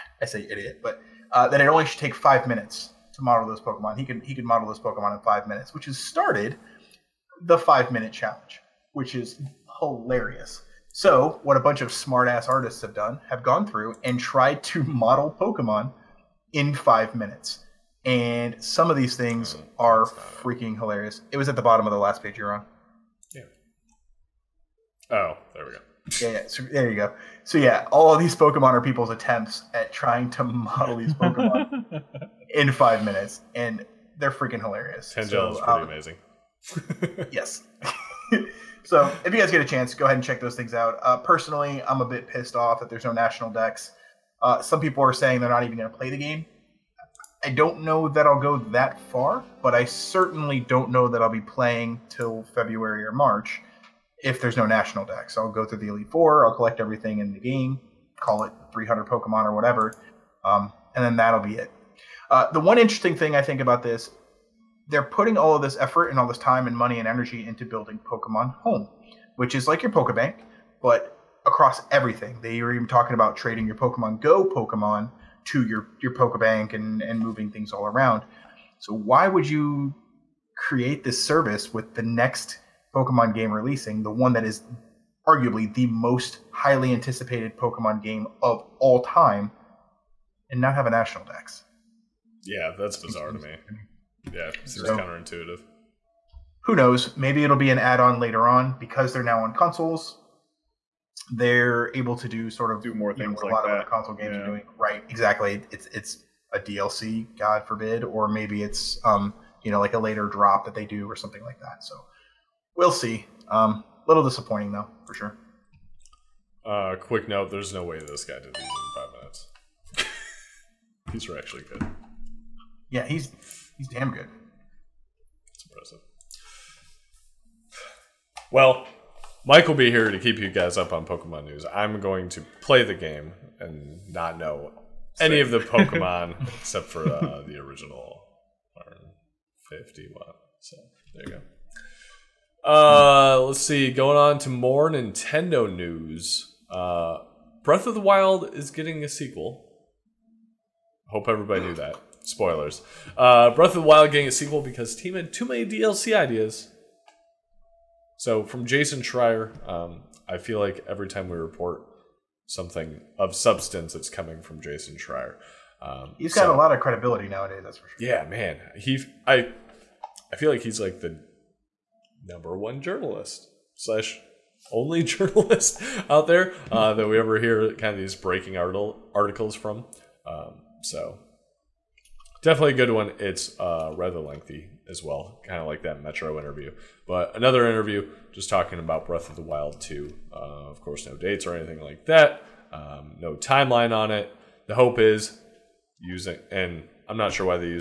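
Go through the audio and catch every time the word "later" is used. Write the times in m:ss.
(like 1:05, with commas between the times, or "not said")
1:38, 1:49.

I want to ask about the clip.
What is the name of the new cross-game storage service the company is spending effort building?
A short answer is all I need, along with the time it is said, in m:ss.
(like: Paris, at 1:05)
Pokemon Home, at 1:08.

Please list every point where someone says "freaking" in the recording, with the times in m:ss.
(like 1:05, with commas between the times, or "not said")
0:20, 0:34.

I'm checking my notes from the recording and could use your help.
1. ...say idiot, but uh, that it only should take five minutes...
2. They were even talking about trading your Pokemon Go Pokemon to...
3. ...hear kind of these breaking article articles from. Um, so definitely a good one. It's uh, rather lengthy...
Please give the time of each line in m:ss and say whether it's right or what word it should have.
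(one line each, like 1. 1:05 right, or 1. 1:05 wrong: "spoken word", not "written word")
1. 0:00 right
2. 1:12 right
3. 2:57 right.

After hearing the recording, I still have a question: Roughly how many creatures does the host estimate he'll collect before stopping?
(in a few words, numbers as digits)
300.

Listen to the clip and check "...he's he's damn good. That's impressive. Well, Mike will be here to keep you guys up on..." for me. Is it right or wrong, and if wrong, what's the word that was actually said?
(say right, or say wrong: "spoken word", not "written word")
right.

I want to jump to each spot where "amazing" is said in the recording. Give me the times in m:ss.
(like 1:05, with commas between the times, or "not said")
0:37.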